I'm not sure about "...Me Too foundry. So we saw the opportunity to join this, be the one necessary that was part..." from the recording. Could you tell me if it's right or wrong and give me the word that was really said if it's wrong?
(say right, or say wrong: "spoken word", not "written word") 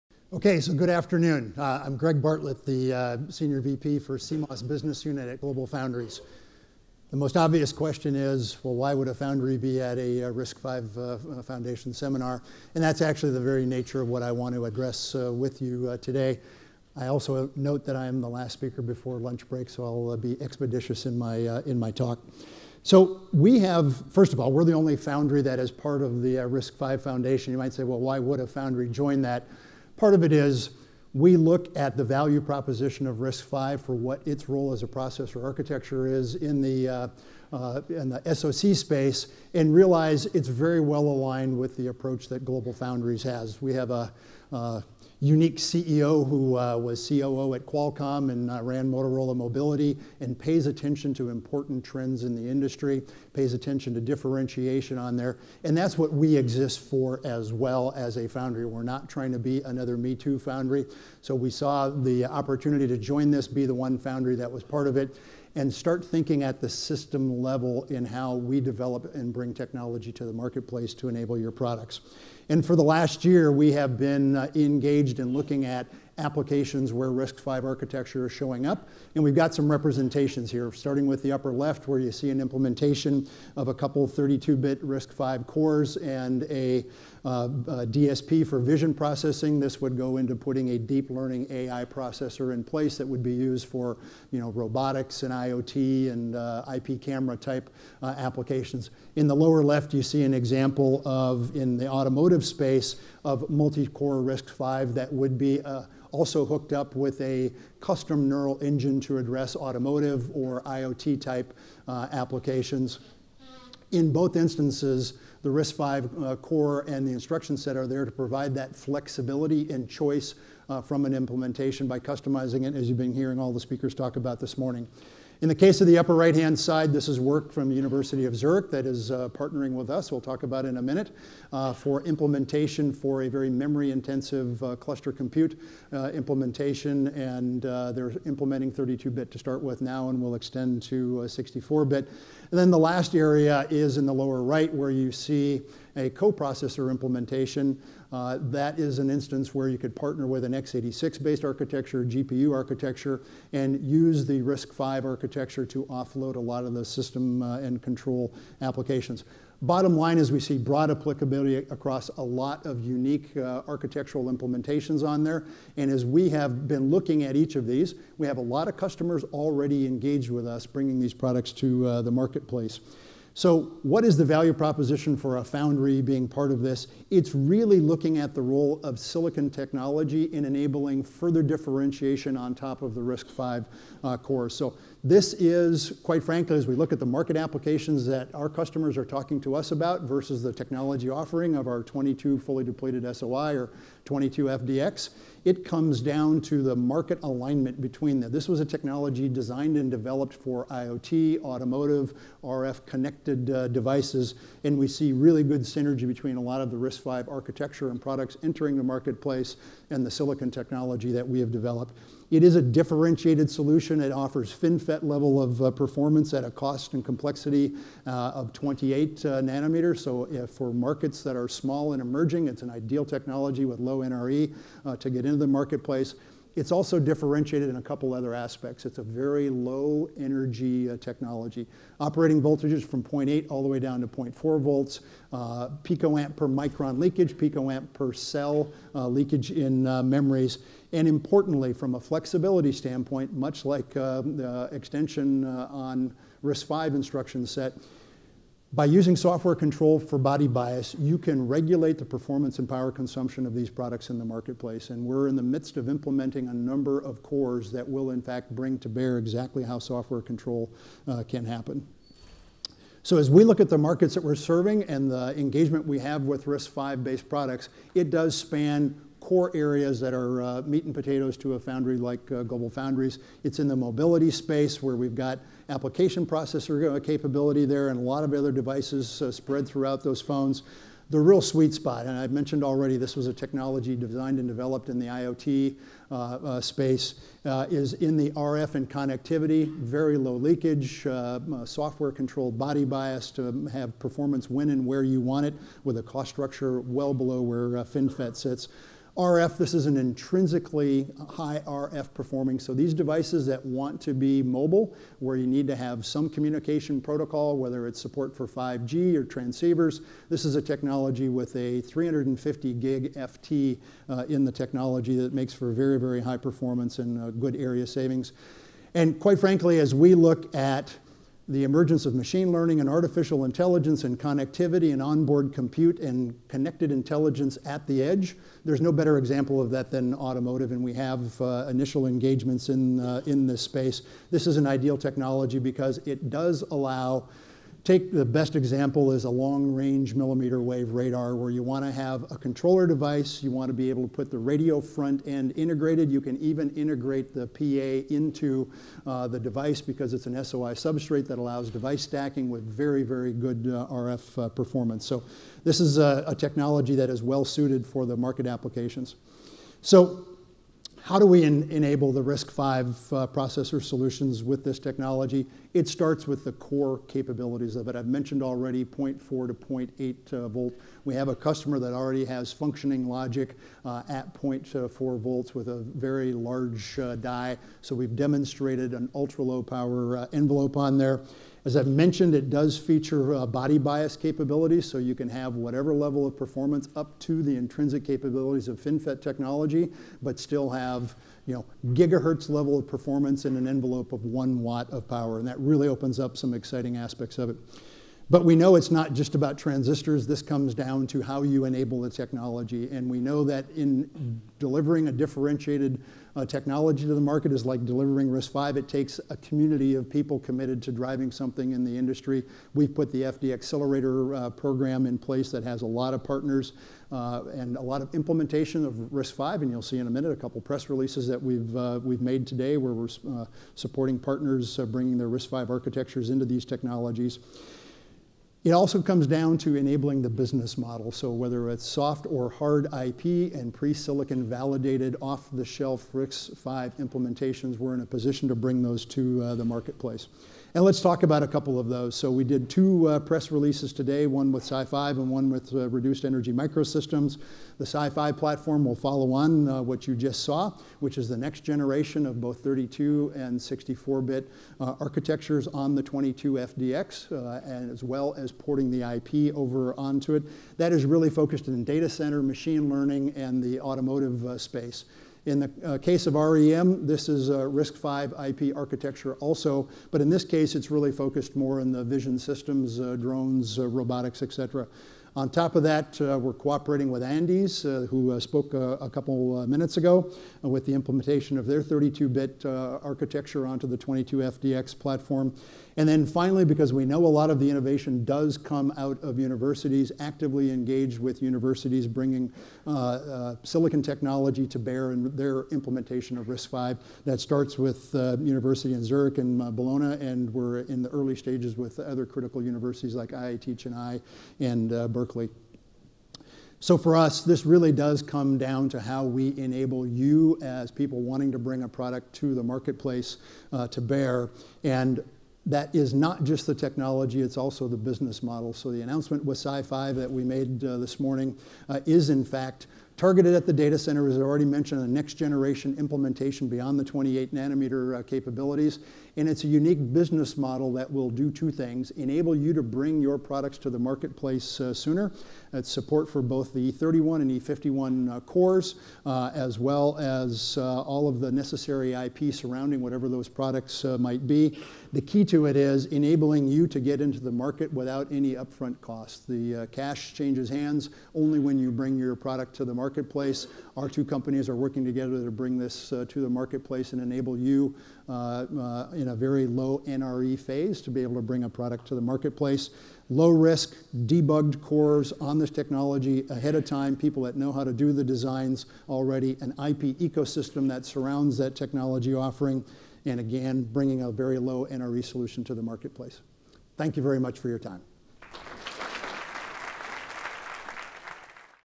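wrong: "foundry", not "necessary".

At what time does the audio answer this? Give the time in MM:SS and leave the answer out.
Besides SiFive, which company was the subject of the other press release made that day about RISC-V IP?
07:25.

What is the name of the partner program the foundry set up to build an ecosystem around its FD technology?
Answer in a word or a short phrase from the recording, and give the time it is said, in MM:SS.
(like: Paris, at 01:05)
FD Accelerator, at 06:53.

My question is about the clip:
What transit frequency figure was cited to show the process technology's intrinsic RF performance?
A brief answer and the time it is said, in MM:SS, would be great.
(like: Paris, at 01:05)
350 gig, at 05:11.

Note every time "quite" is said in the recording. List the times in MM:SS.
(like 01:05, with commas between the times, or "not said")
03:06, 05:19.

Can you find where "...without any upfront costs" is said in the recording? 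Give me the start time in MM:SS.
09:07.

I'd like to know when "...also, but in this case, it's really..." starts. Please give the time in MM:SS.
07:49.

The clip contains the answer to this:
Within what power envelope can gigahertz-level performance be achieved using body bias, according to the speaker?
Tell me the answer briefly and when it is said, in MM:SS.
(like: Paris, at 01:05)
one watt, at 06:34.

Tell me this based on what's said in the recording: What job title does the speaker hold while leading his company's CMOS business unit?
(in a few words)
Senior VP.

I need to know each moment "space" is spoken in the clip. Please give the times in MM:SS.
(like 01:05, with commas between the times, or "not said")
00:38, 01:42, 04:34, 04:46, 05:33, 07:44.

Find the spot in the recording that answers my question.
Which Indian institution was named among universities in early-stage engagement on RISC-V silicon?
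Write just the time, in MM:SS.
08:23.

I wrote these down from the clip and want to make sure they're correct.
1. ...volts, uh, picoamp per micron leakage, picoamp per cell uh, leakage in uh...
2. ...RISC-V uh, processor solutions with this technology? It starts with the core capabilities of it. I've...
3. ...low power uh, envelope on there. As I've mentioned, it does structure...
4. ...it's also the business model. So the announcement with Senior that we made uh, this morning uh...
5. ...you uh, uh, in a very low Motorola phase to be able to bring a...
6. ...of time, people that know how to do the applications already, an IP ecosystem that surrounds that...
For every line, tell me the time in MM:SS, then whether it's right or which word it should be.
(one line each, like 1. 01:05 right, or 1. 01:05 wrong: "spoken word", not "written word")
1. 03:54 right
2. 06:02 right
3. 06:19 wrong: "feature", not "structure"
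4. 08:37 wrong: "SiFive", not "Senior"
5. 09:17 wrong: "NRE", not "Motorola"
6. 09:26 wrong: "designs", not "applications".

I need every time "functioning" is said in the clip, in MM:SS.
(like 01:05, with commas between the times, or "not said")
06:12.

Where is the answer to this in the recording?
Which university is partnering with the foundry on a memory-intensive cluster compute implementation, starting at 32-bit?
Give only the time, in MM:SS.
02:07.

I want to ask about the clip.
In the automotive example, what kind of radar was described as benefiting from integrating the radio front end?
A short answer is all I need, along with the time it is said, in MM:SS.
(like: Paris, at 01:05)
long range millimeter wave, at 05:39.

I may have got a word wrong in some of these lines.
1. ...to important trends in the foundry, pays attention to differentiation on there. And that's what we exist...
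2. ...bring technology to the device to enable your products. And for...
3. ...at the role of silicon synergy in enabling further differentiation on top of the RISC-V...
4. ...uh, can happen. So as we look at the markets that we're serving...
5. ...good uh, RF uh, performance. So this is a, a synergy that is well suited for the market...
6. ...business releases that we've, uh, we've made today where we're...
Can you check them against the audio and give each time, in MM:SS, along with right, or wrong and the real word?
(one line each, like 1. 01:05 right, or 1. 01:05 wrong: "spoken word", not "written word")
1. 00:51 wrong: "industry", not "foundry"
2. 01:09 wrong: "marketplace", not "device"
3. 02:58 wrong: "technology", not "synergy"
4. 04:21 right
5. 05:53 wrong: "technology", not "synergy"
6. 07:00 wrong: "press", not "business".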